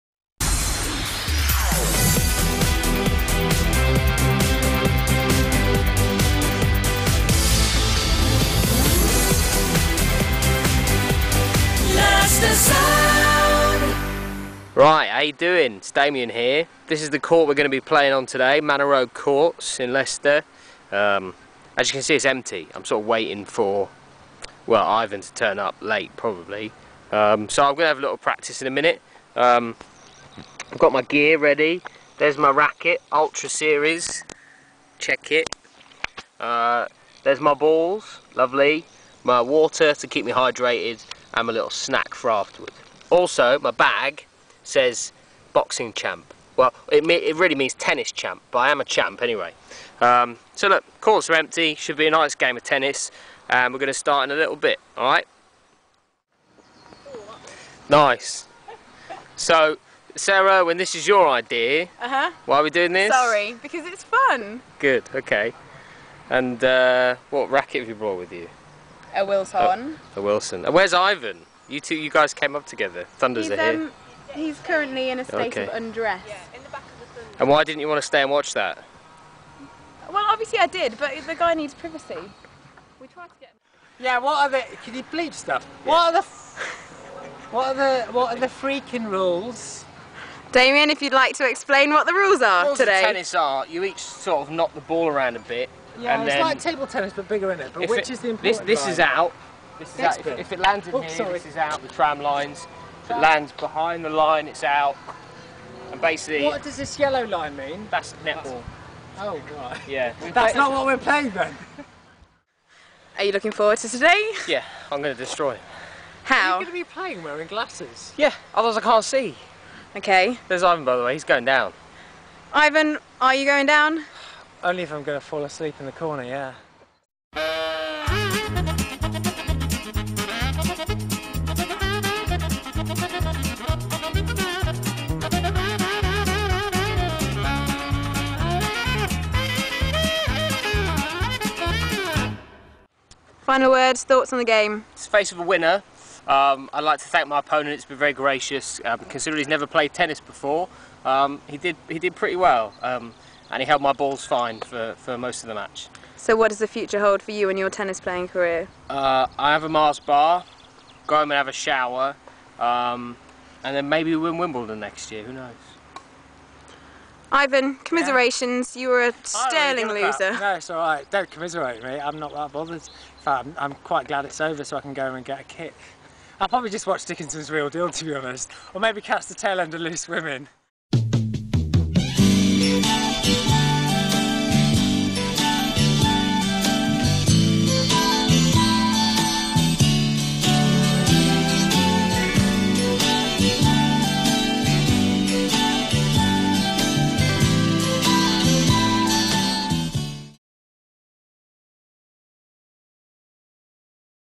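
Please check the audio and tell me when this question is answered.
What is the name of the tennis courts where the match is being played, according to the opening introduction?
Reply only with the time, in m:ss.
0:18.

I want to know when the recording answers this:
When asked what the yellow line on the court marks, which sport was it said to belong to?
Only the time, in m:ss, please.
1:47.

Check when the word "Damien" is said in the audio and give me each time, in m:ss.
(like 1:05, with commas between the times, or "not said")
0:15, 1:30.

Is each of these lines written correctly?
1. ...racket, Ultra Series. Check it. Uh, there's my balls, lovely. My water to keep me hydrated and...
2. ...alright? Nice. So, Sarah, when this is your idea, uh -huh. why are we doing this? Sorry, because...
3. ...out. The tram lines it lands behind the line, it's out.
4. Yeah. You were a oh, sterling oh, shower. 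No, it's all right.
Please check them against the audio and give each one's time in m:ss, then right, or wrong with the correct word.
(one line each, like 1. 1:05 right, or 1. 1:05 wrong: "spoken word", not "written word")
1. 0:32 right
2. 0:54 right
3. 1:41 right
4. 2:48 wrong: "loser", not "shower".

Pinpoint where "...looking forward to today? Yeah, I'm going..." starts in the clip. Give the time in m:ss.
1:53.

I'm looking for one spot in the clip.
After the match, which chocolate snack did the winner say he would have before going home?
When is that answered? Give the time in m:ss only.
2:39.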